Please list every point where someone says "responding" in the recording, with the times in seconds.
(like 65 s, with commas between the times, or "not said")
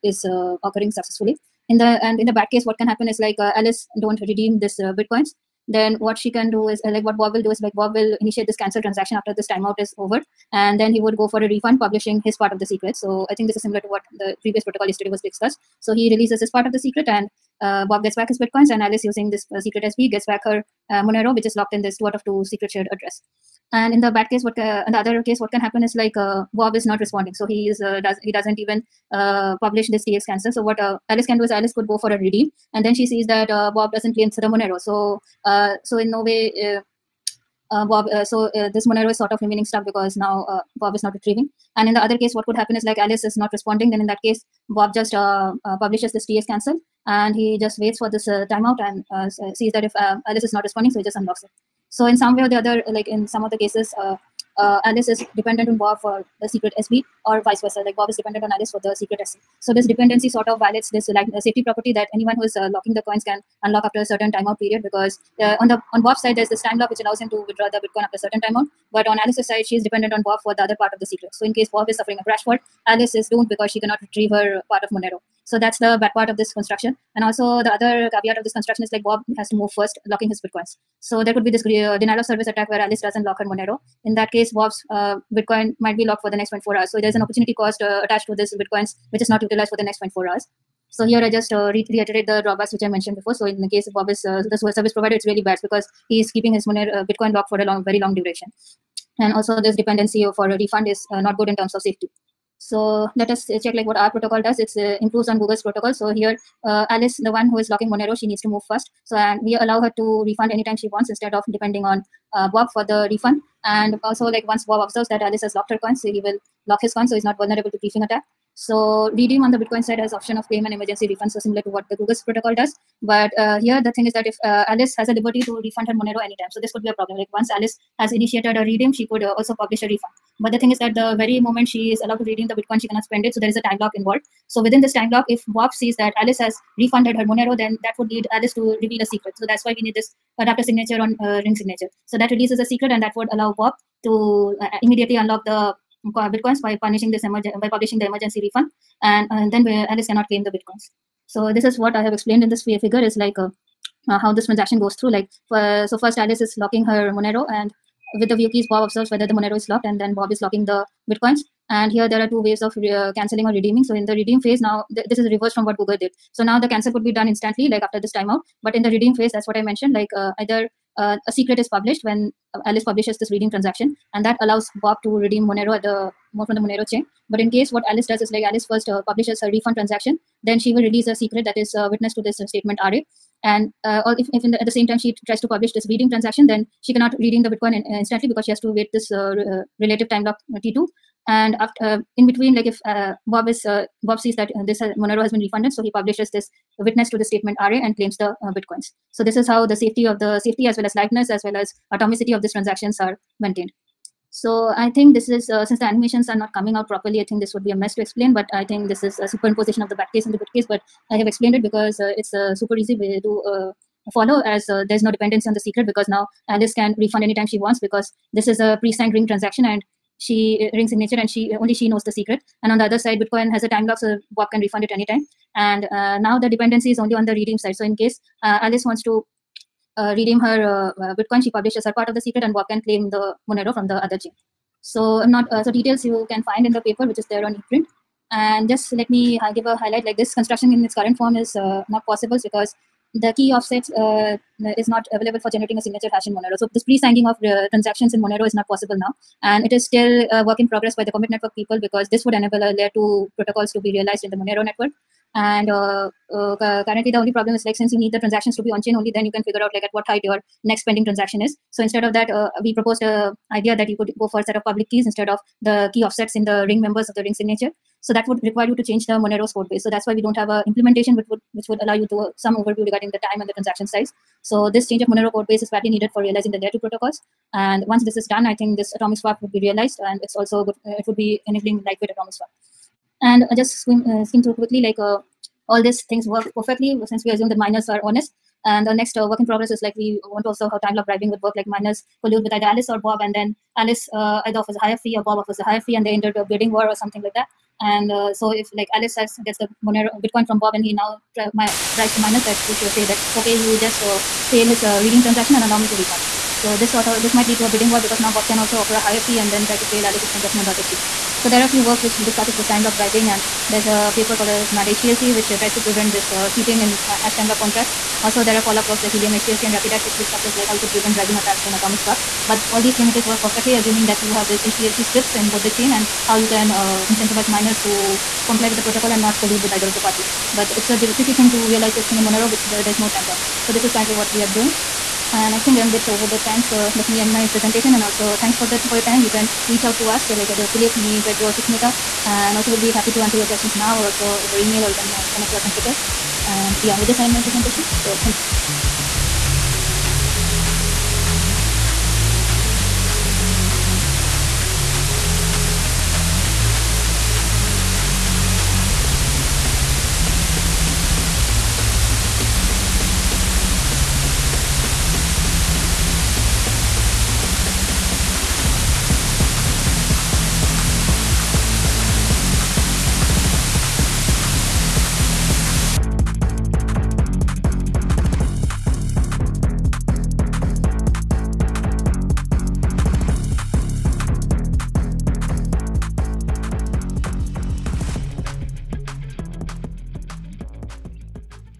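27 s, 43 s, 50 s.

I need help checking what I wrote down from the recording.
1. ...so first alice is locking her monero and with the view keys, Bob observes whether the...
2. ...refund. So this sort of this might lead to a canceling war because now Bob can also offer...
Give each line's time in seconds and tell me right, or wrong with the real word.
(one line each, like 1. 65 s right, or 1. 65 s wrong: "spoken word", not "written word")
1. 155 s right
2. 305 s wrong: "bidding", not "canceling".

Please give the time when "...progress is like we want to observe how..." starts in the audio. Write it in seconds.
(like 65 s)
289 s.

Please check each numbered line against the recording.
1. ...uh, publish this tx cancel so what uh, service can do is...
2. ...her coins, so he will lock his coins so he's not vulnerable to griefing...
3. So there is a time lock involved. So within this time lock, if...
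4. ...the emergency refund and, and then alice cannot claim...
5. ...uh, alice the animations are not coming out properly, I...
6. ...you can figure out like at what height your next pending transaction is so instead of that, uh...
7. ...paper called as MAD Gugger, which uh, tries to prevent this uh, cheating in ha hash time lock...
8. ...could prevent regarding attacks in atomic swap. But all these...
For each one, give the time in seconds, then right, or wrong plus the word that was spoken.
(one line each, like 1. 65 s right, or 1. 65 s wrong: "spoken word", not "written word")
1. 29 s wrong: "alice", not "service"
2. 115 s right
3. 133 s right
4. 147 s right
5. 205 s wrong: "since", not "alice"
6. 259 s right
7. 314 s wrong: "HTLC", not "Gugger"
8. 320 s wrong: "bribing", not "regarding".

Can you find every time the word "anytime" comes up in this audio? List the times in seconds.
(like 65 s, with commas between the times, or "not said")
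110 s, 126 s, 217 s, 224 s.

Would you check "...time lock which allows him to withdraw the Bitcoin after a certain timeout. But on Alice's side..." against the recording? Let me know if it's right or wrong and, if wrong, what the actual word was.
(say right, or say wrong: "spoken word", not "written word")
right.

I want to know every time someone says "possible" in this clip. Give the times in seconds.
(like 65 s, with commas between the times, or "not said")
242 s, 248 s.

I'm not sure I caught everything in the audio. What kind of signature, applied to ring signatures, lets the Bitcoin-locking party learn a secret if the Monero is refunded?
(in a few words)
Adapter signature.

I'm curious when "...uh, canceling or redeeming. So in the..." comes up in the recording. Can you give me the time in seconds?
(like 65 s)
162 s.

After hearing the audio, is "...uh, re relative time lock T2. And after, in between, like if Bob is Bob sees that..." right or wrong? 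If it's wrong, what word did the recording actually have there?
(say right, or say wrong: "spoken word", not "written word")
right.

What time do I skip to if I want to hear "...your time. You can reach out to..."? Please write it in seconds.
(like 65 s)
338 s.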